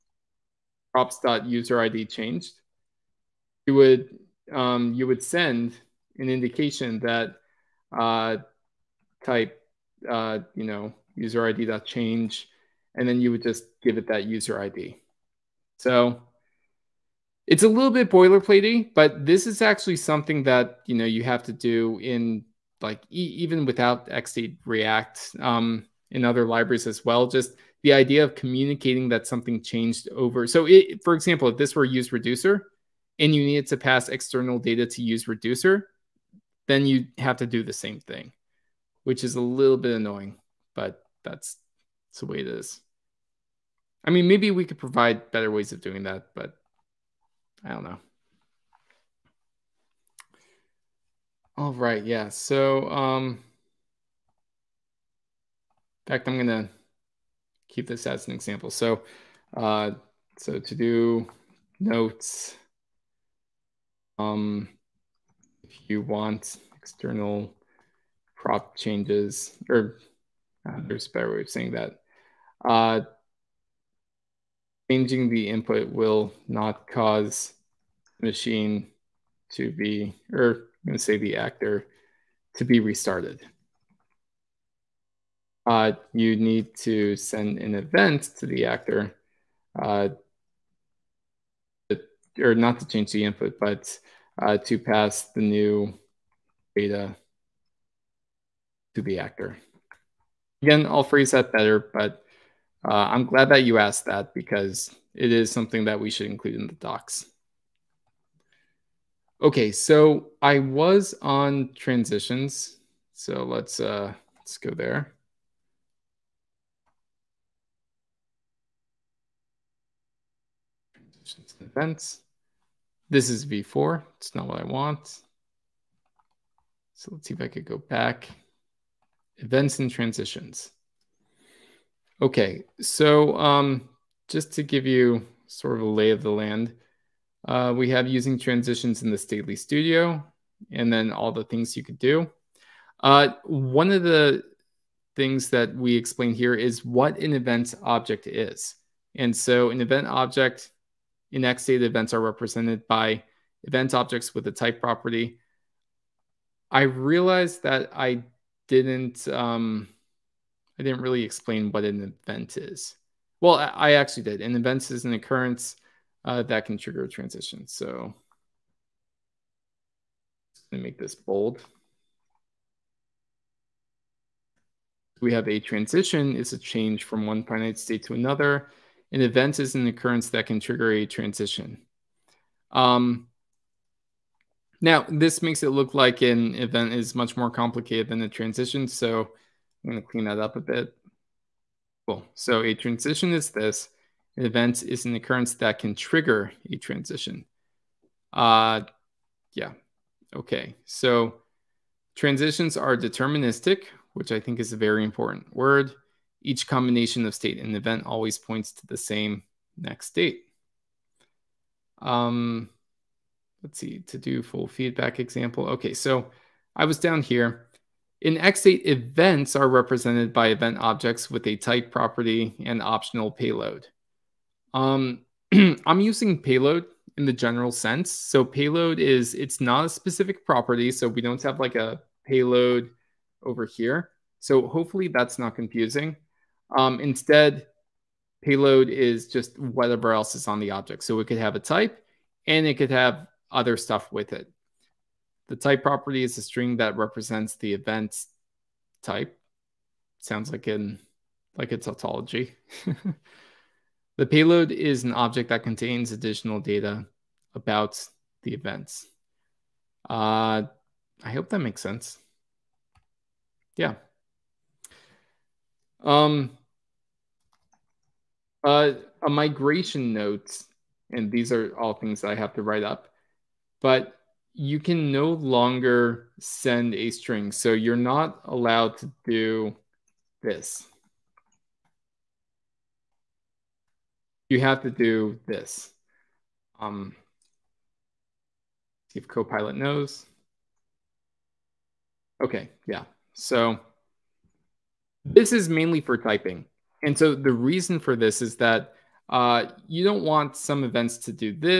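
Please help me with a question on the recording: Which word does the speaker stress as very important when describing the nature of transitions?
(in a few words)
deterministic.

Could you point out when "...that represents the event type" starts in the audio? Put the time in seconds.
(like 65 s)
246 s.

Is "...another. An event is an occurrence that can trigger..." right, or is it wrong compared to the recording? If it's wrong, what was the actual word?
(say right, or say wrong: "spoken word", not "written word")
right.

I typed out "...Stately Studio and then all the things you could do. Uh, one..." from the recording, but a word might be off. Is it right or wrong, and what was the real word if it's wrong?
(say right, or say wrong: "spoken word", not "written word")
right.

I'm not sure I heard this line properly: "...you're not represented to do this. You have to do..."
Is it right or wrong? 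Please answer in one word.
wrong.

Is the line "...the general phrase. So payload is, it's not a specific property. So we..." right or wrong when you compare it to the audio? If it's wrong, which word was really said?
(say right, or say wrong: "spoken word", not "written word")
wrong: "sense", not "phrase".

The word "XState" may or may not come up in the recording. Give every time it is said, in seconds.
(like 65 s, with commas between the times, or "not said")
24 s, 151 s.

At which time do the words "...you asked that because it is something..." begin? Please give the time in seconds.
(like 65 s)
103 s.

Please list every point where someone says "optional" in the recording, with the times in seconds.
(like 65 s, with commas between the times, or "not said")
222 s.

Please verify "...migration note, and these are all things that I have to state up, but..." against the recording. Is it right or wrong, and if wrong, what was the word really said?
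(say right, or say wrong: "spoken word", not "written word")
wrong: "write", not "state".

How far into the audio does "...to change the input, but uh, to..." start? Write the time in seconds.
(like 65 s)
92 s.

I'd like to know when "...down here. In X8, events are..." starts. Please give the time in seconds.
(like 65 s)
216 s.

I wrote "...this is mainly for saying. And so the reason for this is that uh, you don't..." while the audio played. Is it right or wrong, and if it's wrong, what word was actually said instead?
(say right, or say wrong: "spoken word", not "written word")
wrong: "typing", not "saying".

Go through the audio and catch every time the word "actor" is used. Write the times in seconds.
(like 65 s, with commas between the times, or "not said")
81 s, 88 s, 99 s.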